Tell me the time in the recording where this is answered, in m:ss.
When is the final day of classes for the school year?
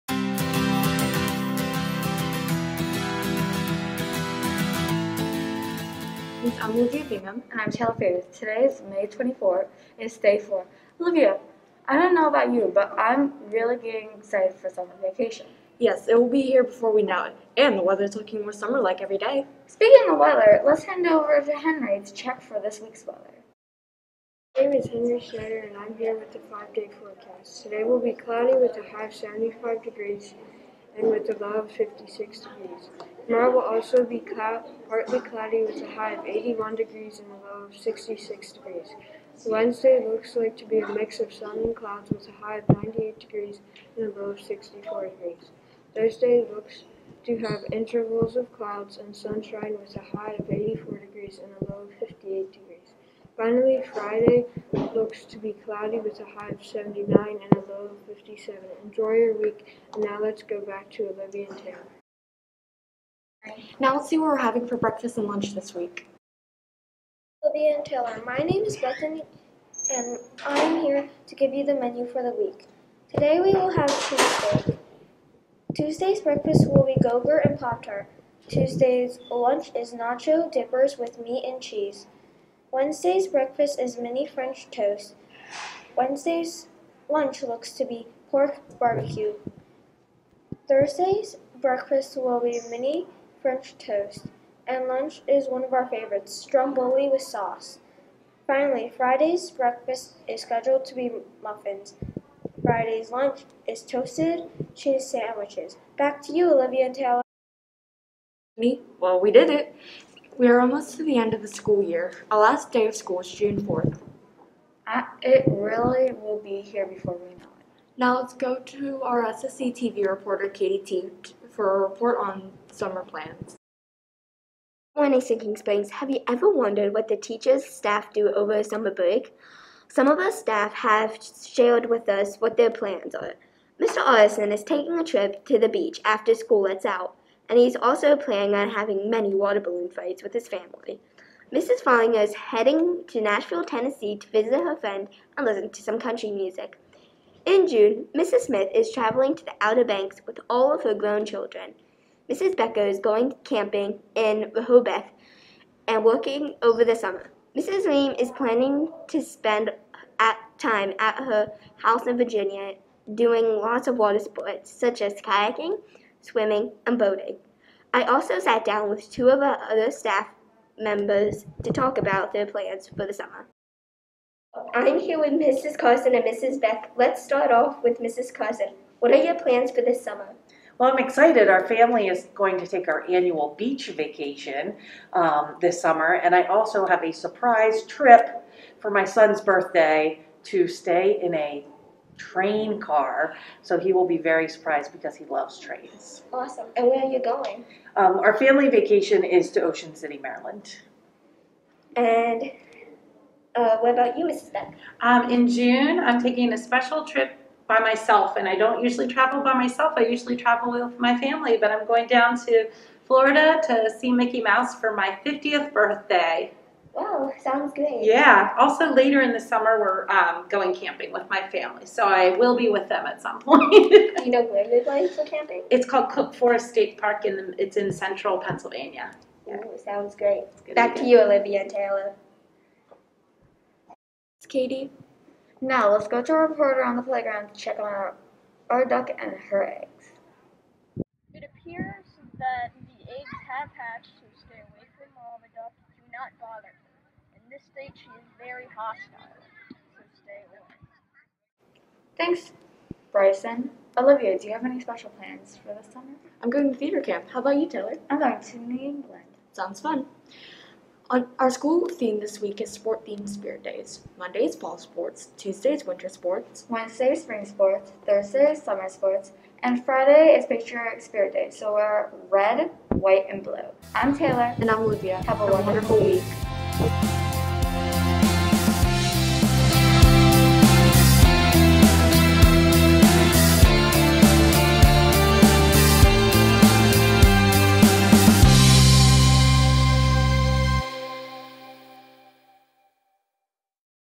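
1:53.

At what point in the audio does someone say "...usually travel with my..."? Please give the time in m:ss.
3:30.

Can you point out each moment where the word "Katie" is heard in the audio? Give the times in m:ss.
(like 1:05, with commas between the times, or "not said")
2:00, 3:54.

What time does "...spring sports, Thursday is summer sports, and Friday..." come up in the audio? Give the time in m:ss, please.
4:27.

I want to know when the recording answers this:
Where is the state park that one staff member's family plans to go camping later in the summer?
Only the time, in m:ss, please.
3:46.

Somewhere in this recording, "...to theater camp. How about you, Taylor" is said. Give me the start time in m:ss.
4:16.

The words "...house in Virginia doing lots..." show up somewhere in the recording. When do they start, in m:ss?
2:41.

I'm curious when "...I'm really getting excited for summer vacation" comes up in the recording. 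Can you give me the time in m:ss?
0:12.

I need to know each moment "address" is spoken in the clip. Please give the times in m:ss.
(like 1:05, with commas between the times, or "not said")
not said.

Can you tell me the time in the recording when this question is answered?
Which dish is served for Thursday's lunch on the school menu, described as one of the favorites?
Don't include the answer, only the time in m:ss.
1:36.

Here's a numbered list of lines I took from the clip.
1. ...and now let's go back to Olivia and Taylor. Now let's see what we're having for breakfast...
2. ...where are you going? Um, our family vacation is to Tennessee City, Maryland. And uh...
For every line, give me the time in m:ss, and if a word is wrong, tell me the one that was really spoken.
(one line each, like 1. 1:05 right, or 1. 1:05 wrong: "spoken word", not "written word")
1. 0:59 right
2. 3:16 wrong: "Ocean", not "Tennessee".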